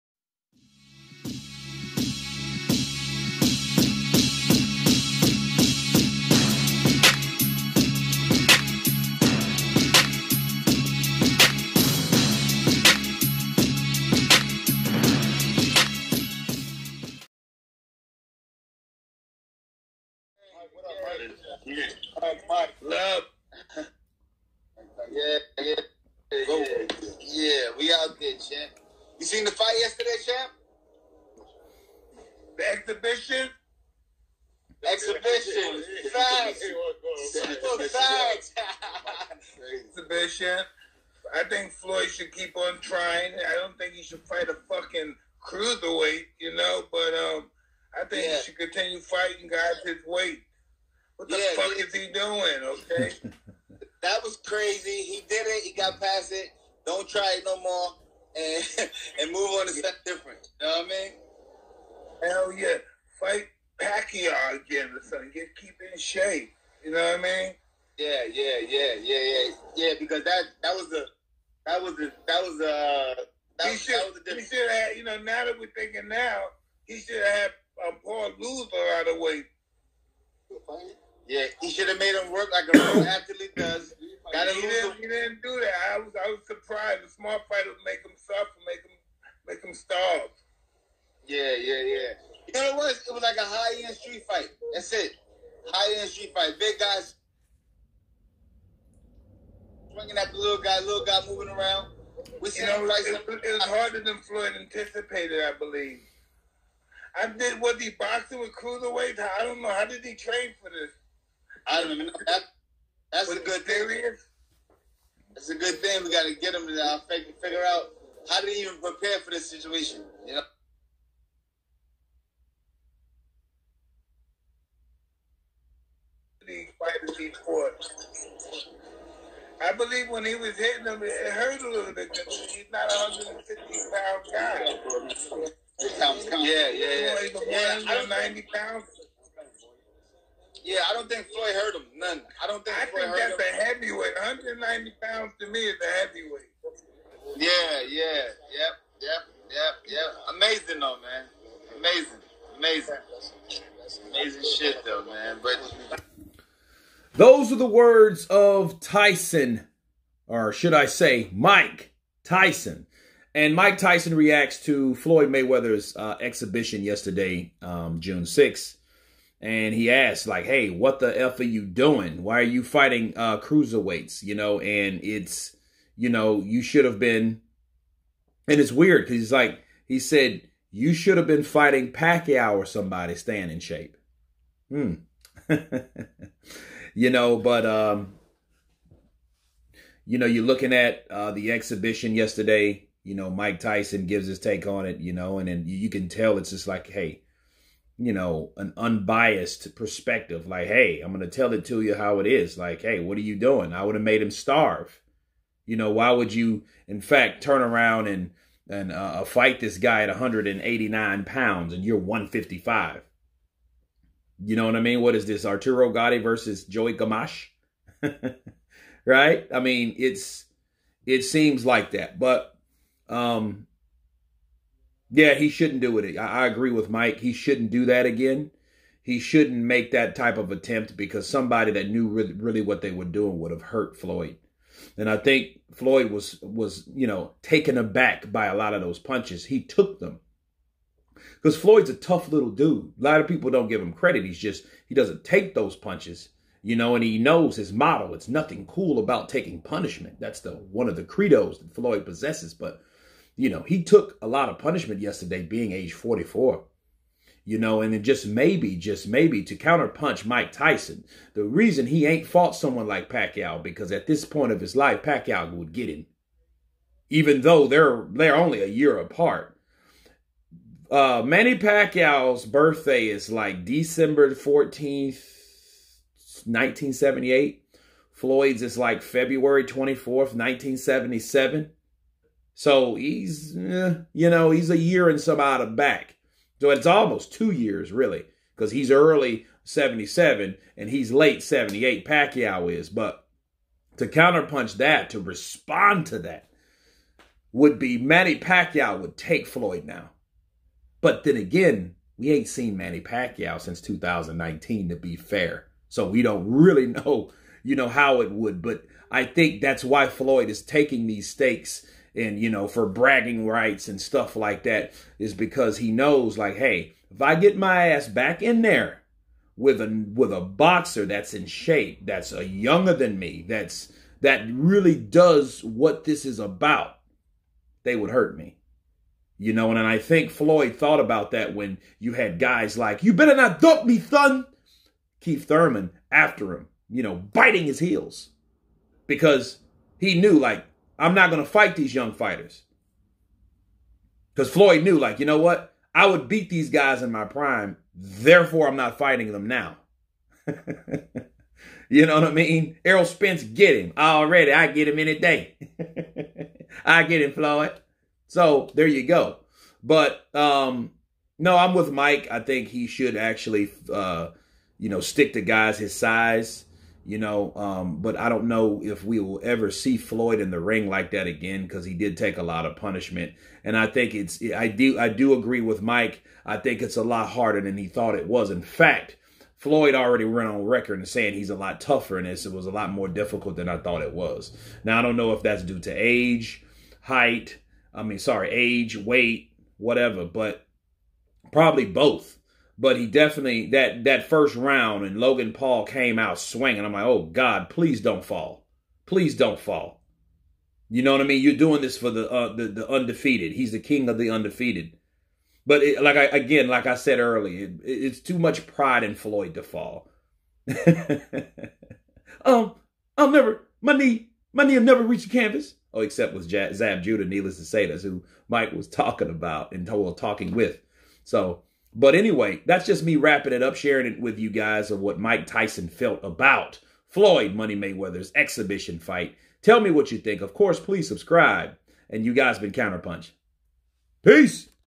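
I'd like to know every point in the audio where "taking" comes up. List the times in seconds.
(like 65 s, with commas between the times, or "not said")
249 s, 310 s.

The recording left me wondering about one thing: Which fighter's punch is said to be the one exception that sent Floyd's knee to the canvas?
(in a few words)
Zab Judah.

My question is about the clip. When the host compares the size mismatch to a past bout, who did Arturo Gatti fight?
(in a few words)
Joey Gamache.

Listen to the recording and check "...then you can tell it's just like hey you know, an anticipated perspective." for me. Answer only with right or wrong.
wrong.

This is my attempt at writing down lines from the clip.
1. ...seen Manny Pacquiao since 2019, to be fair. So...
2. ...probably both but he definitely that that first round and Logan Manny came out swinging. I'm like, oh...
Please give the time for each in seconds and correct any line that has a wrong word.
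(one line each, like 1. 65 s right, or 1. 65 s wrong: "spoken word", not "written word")
1. 302 s right
2. 391 s wrong: "Paul", not "Manny".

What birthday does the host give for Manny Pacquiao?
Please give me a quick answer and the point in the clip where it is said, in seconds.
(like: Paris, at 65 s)
December 14th, 1978, at 273 s.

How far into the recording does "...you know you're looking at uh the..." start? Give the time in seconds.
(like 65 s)
190 s.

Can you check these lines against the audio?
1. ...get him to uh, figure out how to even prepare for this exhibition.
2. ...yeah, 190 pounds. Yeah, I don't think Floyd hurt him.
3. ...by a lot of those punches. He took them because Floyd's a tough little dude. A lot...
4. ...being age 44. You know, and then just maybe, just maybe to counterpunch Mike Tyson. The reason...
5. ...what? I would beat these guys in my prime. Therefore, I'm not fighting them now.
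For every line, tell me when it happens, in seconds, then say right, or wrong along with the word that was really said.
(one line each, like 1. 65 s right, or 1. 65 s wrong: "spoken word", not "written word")
1. 116 s wrong: "situation", not "exhibition"
2. 137 s right
3. 238 s right
4. 255 s right
5. 345 s right.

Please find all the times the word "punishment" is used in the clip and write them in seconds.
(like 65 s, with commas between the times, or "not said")
249 s, 254 s, 372 s.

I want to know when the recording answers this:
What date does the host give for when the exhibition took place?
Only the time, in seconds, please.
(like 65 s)
168 s.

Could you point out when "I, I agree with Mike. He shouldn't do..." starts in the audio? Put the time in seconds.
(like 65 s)
226 s.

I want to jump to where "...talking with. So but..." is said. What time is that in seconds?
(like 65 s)
419 s.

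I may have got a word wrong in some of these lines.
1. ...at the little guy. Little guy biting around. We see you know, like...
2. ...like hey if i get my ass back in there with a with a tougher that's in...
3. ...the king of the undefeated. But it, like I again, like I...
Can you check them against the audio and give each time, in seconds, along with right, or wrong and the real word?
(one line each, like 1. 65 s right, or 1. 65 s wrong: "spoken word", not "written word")
1. 100 s wrong: "moving", not "biting"
2. 316 s wrong: "boxer", not "tougher"
3. 403 s right.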